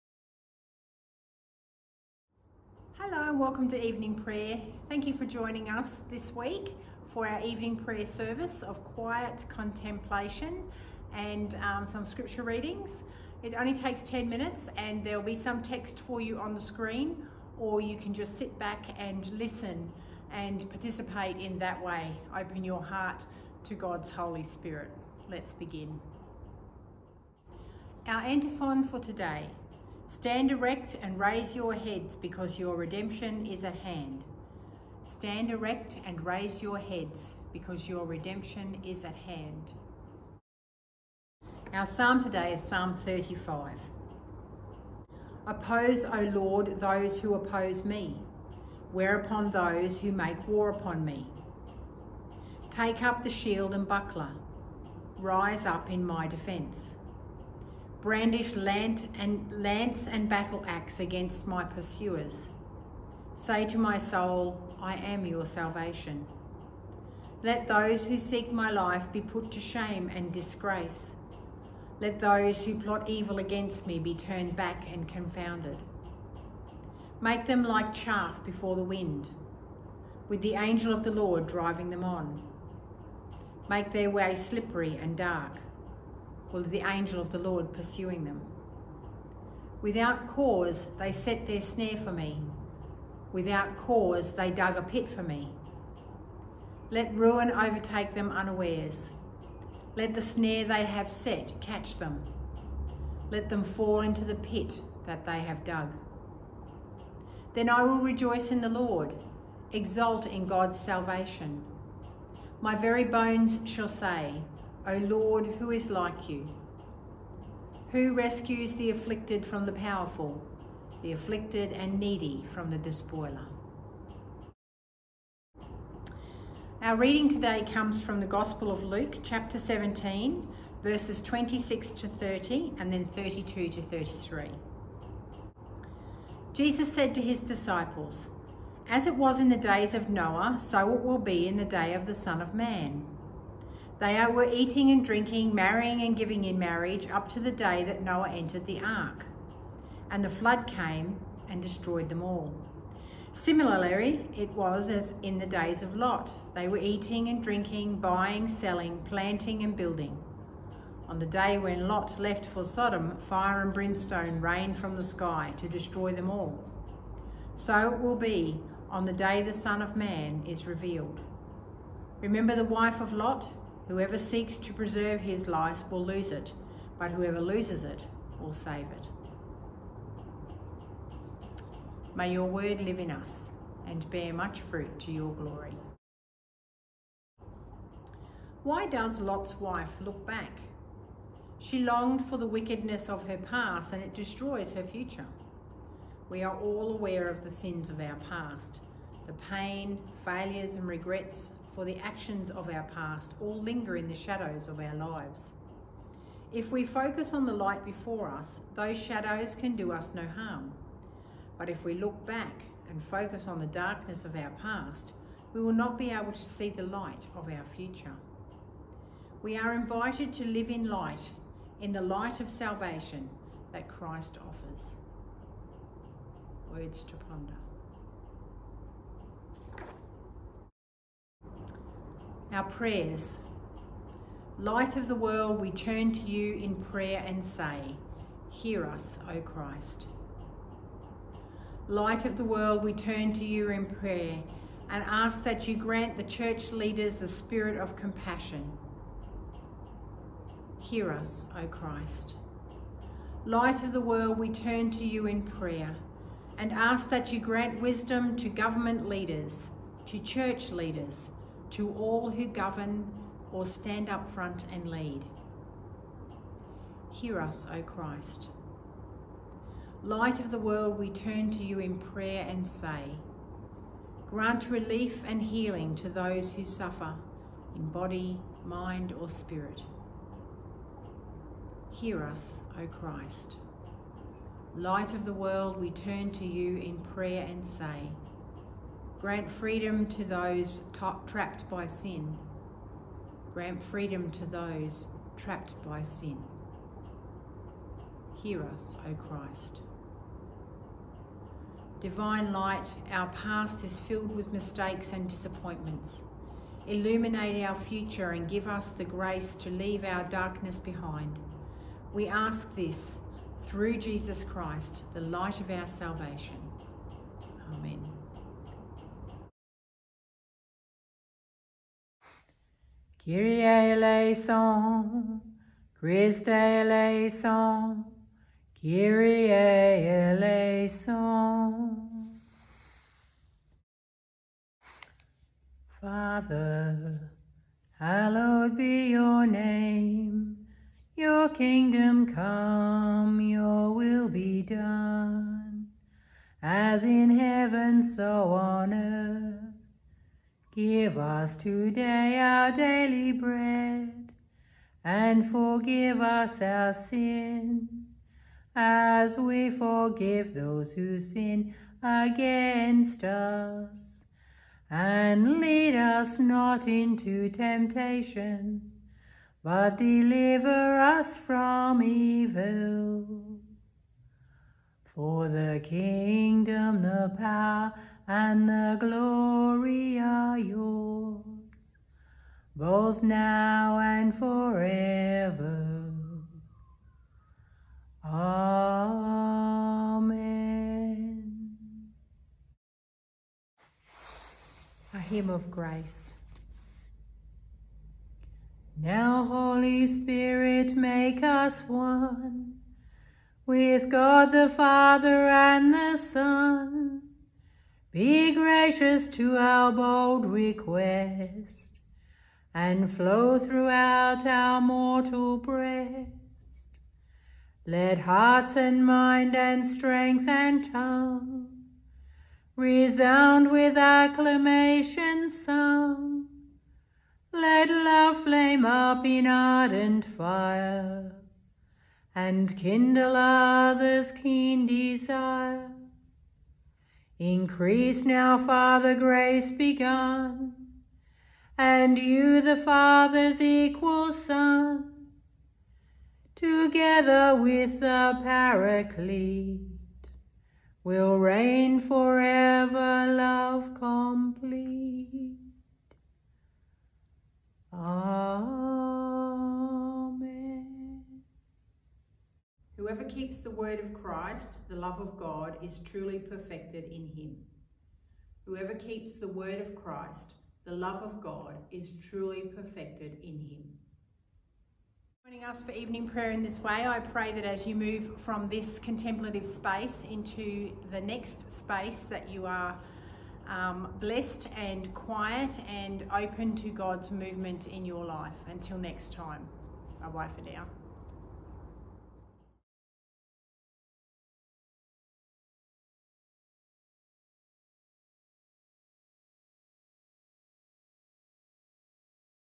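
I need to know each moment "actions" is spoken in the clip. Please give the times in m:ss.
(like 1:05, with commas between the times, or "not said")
3:21.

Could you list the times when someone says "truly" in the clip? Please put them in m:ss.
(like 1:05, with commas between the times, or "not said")
7:45, 7:52.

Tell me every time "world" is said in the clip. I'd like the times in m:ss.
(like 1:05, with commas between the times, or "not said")
3:55, 4:02, 4:14, 4:30, 4:45.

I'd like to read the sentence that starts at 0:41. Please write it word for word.
Our psalm today is Psalm 35.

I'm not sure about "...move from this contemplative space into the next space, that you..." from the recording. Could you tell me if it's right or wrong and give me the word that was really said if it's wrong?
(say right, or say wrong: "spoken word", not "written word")
right.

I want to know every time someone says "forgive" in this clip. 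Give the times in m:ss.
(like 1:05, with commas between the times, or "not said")
5:55, 5:59.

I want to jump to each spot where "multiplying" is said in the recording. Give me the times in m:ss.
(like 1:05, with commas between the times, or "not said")
not said.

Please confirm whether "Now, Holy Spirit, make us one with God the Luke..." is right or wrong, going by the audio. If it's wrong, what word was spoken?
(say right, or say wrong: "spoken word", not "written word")
wrong: "Father", not "Luke".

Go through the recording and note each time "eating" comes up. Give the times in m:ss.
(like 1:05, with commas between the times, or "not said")
2:24, 2:36.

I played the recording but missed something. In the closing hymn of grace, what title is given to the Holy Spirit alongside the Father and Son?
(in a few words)
Paraclete.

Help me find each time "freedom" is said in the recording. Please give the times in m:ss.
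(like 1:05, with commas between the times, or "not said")
4:49, 4:53.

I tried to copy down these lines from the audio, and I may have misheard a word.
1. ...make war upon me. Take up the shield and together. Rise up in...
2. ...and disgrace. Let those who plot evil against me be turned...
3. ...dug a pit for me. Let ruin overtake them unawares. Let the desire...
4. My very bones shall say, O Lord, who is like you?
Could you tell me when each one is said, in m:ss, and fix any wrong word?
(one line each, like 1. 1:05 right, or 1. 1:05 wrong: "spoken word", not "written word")
1. 0:50 wrong: "buckler", not "together"
2. 1:10 right
3. 1:34 wrong: "snare", not "desire"
4. 1:52 right.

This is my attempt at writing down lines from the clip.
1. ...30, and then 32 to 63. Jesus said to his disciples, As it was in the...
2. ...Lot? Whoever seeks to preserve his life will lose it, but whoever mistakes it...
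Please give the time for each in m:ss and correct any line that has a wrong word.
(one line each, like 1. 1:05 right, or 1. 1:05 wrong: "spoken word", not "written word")
1. 2:12 wrong: "33", not "63"
2. 2:53 wrong: "loses", not "mistakes".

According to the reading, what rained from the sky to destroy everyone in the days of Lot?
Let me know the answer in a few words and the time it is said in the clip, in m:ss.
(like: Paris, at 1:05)
Fire and brimstone, at 2:43.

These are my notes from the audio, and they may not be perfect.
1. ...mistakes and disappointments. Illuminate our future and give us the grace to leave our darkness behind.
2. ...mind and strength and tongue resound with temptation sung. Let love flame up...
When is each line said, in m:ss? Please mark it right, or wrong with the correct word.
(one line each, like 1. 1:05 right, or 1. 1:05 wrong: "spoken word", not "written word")
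1. 5:04 right
2. 6:59 wrong: "acclamation", not "temptation".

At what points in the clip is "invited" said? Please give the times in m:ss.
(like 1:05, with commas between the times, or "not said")
3:39.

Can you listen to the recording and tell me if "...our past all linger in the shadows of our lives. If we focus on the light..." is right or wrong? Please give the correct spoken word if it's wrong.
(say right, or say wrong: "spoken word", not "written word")
right.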